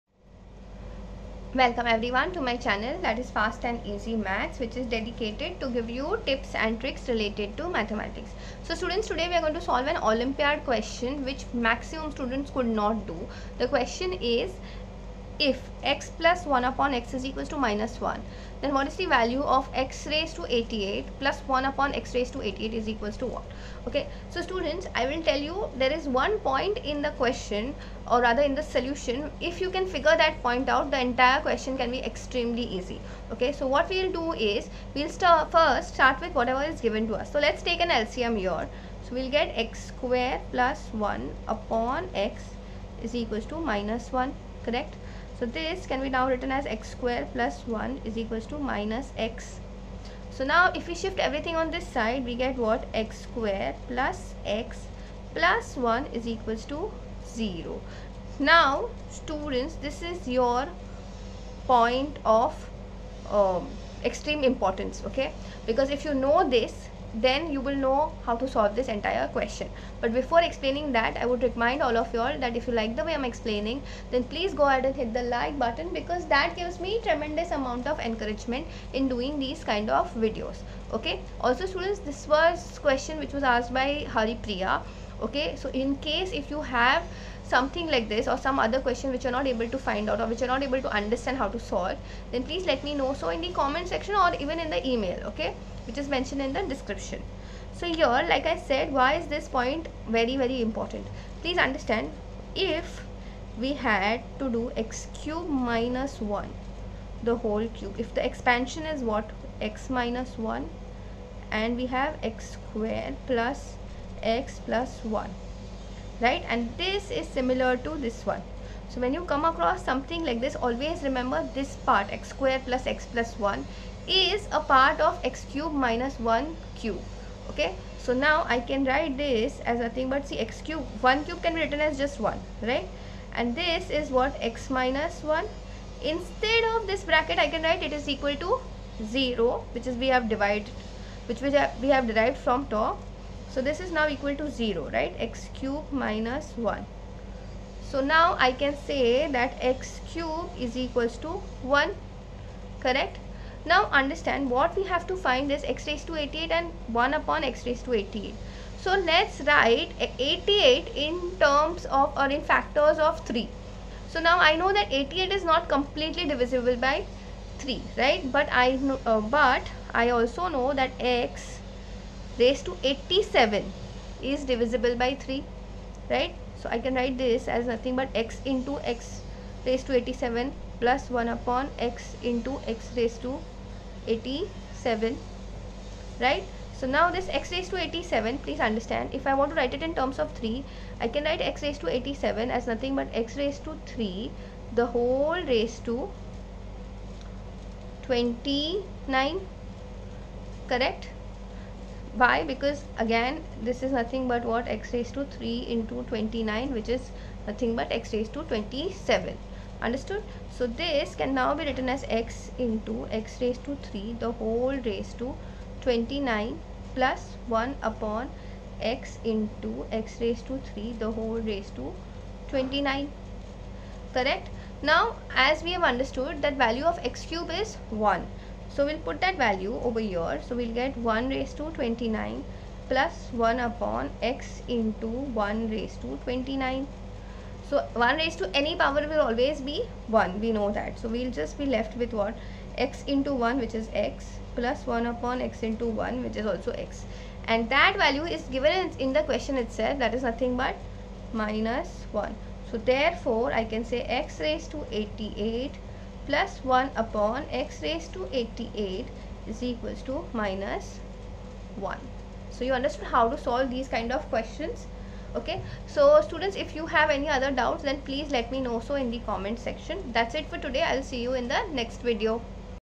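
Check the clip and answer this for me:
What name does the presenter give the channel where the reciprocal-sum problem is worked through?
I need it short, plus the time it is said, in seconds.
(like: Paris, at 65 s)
Fast and Easy Maths, at 3 s.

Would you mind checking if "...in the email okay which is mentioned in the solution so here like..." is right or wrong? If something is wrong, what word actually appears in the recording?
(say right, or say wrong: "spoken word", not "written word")
wrong: "description", not "solution".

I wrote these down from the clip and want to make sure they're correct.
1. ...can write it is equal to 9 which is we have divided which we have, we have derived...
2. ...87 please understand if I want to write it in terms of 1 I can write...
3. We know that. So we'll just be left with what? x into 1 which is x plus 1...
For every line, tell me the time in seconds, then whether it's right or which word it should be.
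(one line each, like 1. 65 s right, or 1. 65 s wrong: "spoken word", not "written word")
1. 137 s wrong: "0", not "9"
2. 187 s wrong: "3", not "1"
3. 240 s right.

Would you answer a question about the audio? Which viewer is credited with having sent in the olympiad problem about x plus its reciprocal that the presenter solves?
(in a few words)
Hari Priya.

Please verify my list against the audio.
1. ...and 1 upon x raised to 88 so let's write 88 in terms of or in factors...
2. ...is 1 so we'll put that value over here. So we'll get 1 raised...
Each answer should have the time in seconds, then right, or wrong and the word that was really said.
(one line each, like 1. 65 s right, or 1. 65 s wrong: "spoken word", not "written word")
1. 156 s right
2. 227 s right.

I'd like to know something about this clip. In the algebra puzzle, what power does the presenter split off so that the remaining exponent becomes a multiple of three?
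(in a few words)
87.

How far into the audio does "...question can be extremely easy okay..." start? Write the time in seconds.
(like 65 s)
31 s.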